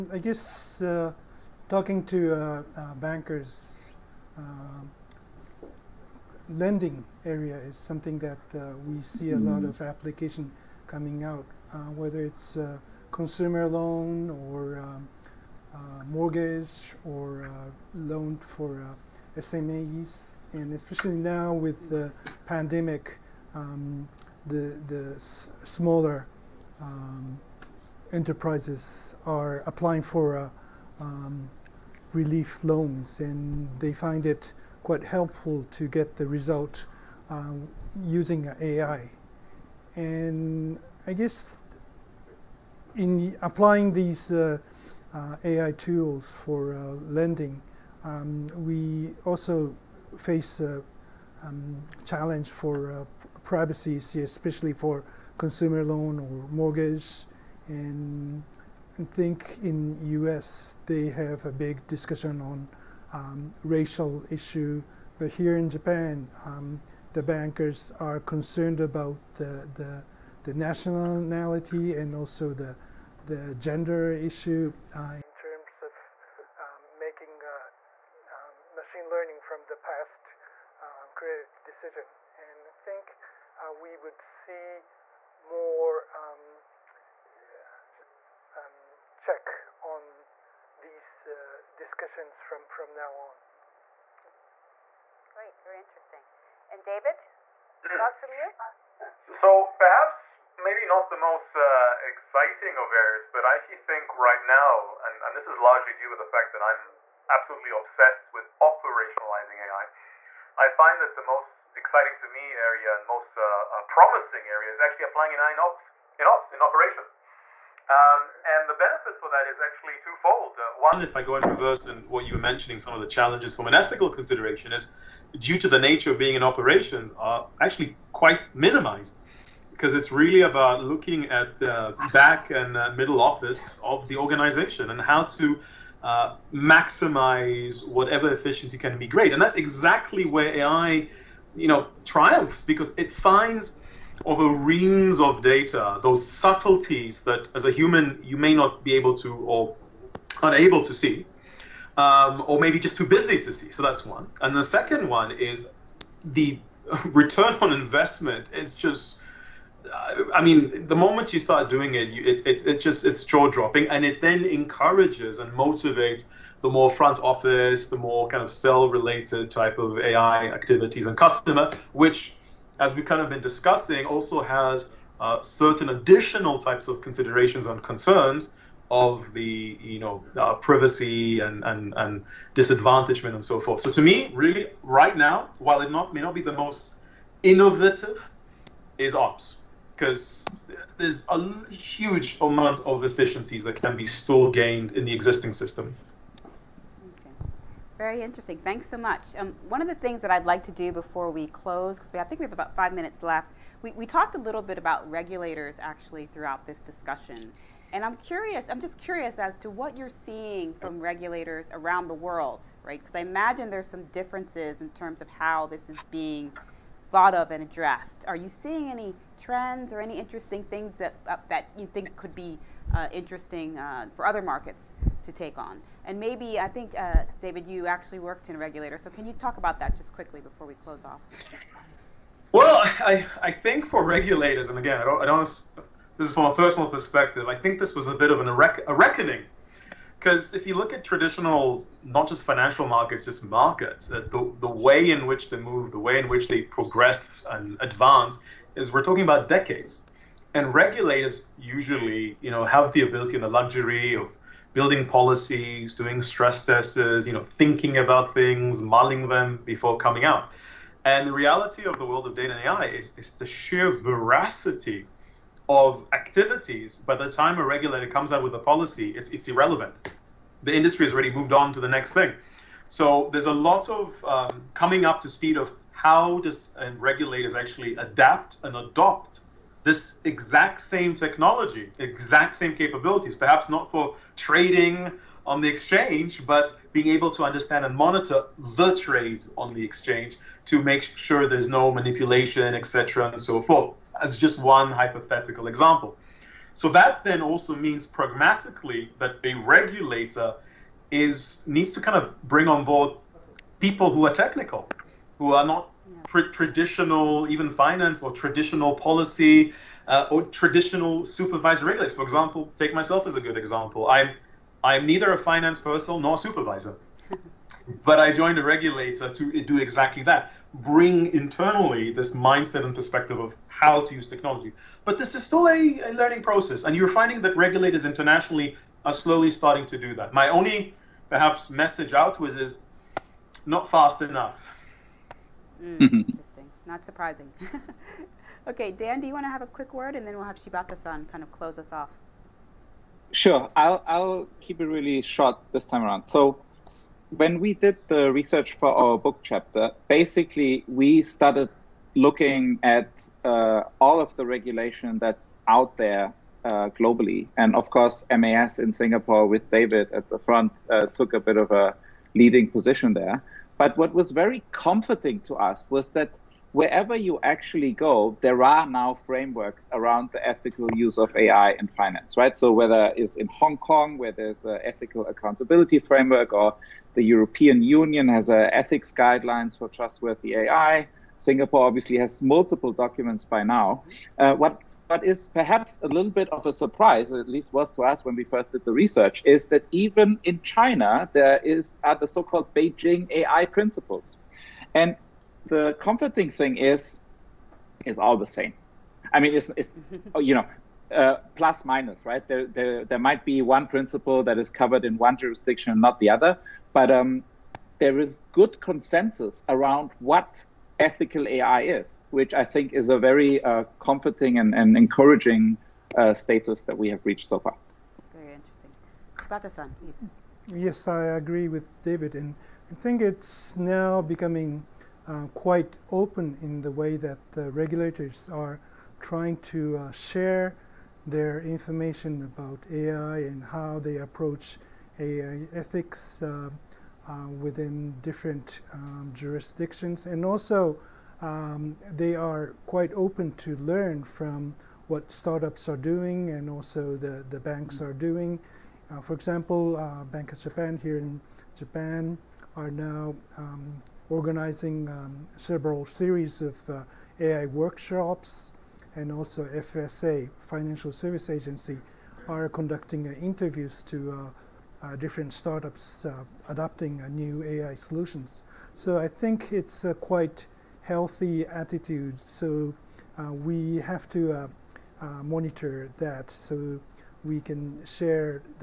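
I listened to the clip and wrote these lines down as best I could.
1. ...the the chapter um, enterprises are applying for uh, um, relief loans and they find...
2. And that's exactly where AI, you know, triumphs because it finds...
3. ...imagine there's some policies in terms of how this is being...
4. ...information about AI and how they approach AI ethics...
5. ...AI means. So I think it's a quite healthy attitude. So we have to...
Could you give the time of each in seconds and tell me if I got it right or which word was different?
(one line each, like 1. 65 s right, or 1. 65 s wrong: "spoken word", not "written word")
1. 24 s wrong: "smaller", not "chapter"
2. 139 s right
3. 213 s wrong: "differences", not "policies"
4. 431 s right
5. 467 s wrong: "solutions", not "means".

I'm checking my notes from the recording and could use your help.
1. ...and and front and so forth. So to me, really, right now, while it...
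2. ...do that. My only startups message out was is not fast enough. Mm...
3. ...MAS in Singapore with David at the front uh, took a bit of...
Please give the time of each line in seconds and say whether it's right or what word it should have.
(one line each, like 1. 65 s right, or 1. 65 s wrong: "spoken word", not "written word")
1. 181 s wrong: "disadvantagement", not "front"
2. 329 s wrong: "perhaps", not "startups"
3. 358 s right.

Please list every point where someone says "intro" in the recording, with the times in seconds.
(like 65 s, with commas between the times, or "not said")
not said.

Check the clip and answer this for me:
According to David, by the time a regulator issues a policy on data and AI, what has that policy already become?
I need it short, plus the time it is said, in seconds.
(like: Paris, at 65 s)
Irrelevant, at 269 s.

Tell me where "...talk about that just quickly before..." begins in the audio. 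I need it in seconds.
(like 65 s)
229 s.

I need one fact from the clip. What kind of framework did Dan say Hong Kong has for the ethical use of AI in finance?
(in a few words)
Ethical accountability framework.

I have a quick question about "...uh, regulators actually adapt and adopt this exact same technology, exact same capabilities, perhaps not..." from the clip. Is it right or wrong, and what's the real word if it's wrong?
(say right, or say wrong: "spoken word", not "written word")
right.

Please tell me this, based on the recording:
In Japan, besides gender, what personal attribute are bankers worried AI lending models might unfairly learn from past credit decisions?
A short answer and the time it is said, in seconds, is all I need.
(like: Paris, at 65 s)
Nationality, at 70 s.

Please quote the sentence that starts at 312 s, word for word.
For example, take myself as a good example.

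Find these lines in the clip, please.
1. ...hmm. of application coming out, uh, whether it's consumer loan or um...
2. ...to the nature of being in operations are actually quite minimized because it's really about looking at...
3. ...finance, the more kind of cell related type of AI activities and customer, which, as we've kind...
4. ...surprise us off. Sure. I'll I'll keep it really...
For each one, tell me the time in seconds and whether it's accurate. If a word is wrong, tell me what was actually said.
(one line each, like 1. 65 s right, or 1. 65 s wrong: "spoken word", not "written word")
1. 9 s right
2. 125 s right
3. 167 s wrong: "office", not "finance"
4. 341 s wrong: "close", not "surprise".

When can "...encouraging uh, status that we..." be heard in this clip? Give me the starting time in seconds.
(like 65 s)
414 s.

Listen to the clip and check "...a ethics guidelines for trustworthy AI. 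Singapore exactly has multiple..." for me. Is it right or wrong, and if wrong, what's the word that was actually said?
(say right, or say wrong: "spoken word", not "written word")
wrong: "obviously", not "exactly".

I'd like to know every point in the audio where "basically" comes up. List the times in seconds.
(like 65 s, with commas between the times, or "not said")
350 s.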